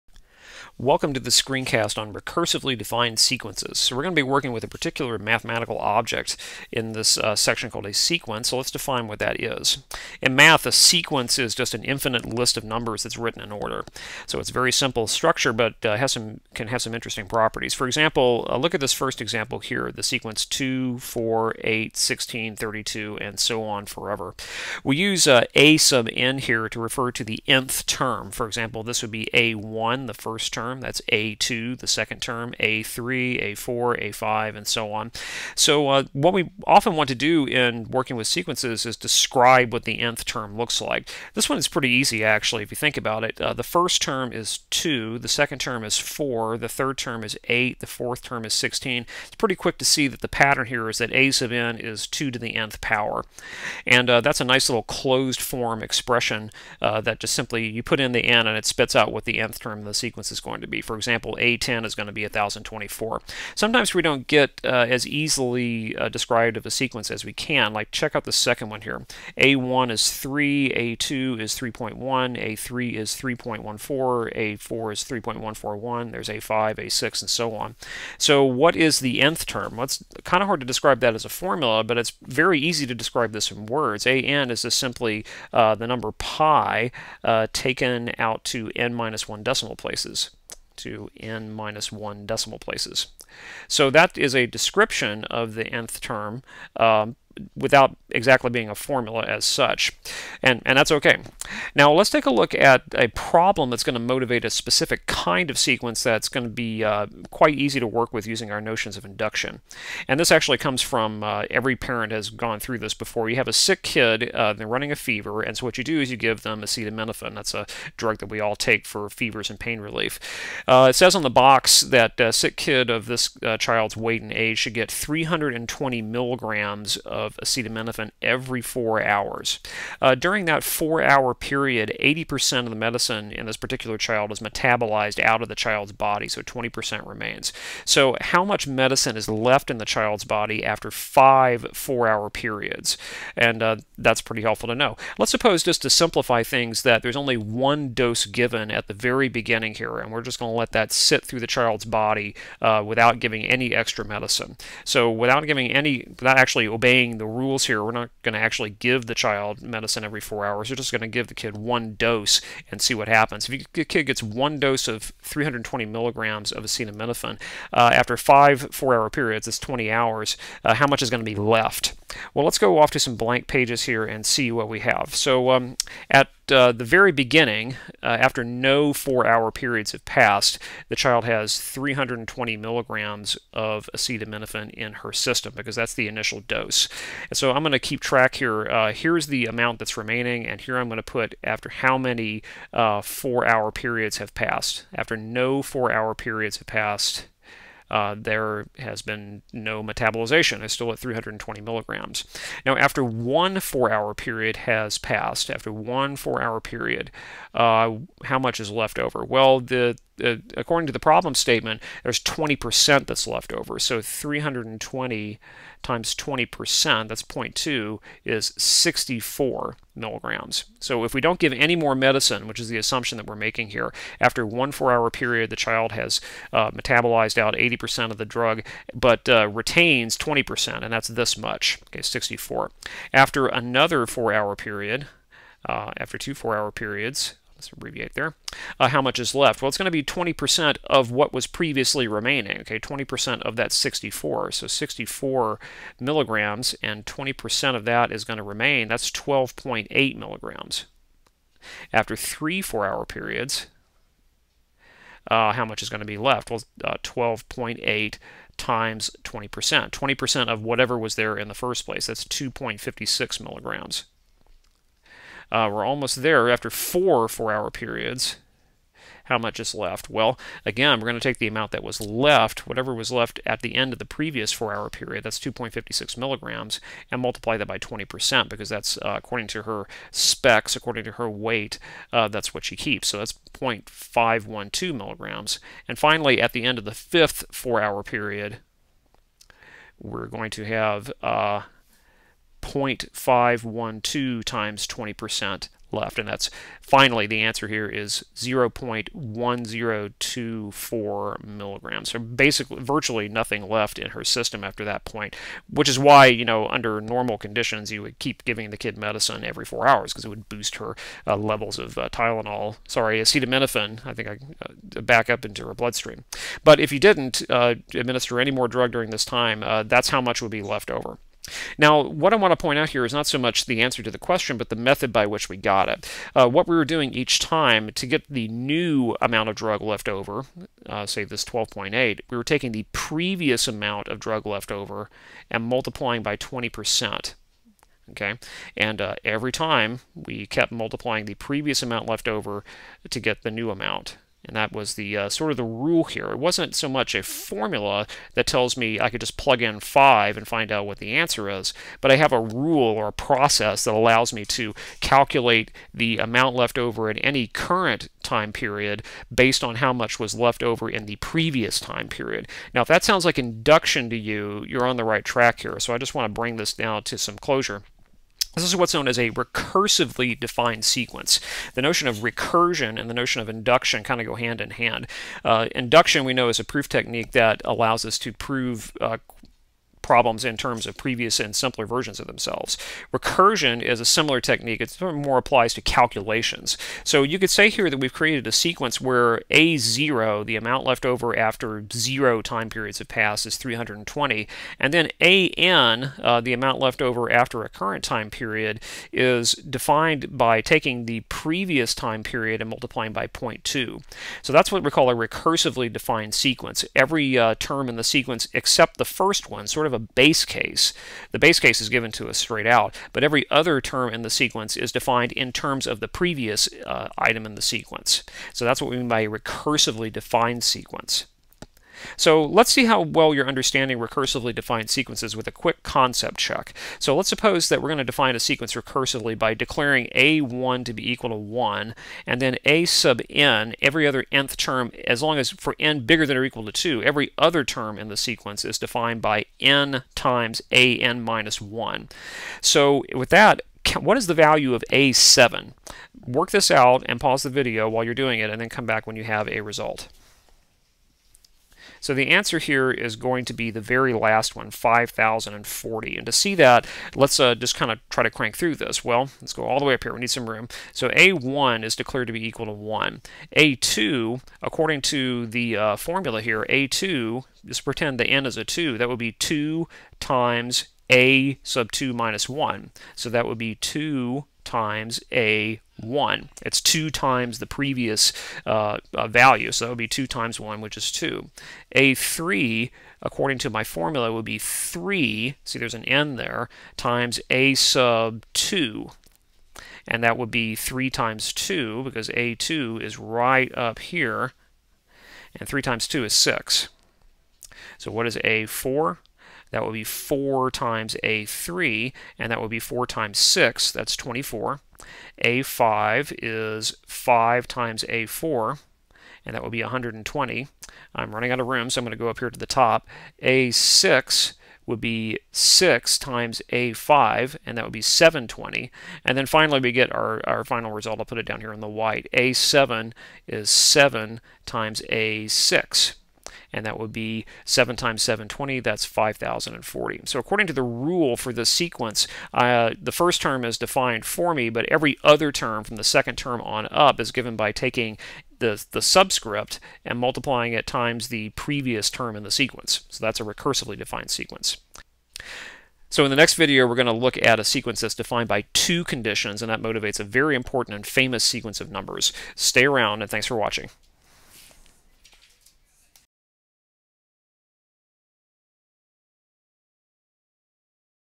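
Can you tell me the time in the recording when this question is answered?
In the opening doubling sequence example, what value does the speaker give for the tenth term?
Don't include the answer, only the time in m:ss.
1:02.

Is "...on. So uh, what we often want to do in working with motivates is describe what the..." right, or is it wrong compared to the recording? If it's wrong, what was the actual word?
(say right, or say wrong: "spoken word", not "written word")
wrong: "sequences", not "motivates".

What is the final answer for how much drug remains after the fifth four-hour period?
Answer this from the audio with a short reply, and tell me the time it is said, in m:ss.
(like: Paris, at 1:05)
0.1024 milligrams, at 4:58.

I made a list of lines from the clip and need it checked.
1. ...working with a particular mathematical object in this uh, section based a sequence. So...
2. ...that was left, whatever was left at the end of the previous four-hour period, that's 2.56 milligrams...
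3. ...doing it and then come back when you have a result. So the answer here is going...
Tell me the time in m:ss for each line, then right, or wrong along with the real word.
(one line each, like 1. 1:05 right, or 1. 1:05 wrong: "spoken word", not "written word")
1. 0:04 wrong: "called", not "based"
2. 4:31 right
3. 7:28 right.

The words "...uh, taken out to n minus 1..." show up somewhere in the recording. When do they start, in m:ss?
1:27.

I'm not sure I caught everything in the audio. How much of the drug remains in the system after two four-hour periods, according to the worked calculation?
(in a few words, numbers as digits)
12.8 milligrams.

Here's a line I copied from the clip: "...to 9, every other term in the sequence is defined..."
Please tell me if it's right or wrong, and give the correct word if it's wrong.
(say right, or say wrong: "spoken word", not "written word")
wrong: "2", not "9".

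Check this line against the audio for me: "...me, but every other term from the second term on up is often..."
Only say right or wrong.
wrong.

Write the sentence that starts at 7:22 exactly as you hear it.
So with that, what is the value of A7?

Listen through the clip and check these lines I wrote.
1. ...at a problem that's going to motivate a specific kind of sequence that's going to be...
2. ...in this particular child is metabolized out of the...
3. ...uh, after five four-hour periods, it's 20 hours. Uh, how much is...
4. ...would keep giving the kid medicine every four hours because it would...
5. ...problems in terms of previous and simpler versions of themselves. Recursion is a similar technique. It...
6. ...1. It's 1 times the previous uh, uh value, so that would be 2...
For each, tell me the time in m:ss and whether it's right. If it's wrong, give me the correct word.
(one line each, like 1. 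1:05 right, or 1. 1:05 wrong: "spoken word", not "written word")
1. 1:42 right
2. 2:13 right
3. 2:47 right
4. 5:08 right
5. 6:20 right
6. 7:55 wrong: "2", not "1".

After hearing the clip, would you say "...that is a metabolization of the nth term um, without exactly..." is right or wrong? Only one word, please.
wrong.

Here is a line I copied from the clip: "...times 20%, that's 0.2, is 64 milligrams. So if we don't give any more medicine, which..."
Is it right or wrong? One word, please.
right.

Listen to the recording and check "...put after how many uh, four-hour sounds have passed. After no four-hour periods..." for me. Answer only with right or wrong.
wrong.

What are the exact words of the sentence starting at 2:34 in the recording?
So, without giving any, without actually obeying the rules here.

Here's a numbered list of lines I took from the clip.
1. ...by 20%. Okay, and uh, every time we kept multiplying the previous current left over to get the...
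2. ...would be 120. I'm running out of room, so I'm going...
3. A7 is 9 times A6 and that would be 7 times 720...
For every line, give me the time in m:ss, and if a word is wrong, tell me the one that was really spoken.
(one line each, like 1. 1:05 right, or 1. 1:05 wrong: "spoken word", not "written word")
1. 5:36 wrong: "amount", not "current"
2. 8:29 right
3. 8:42 wrong: "7", not "9".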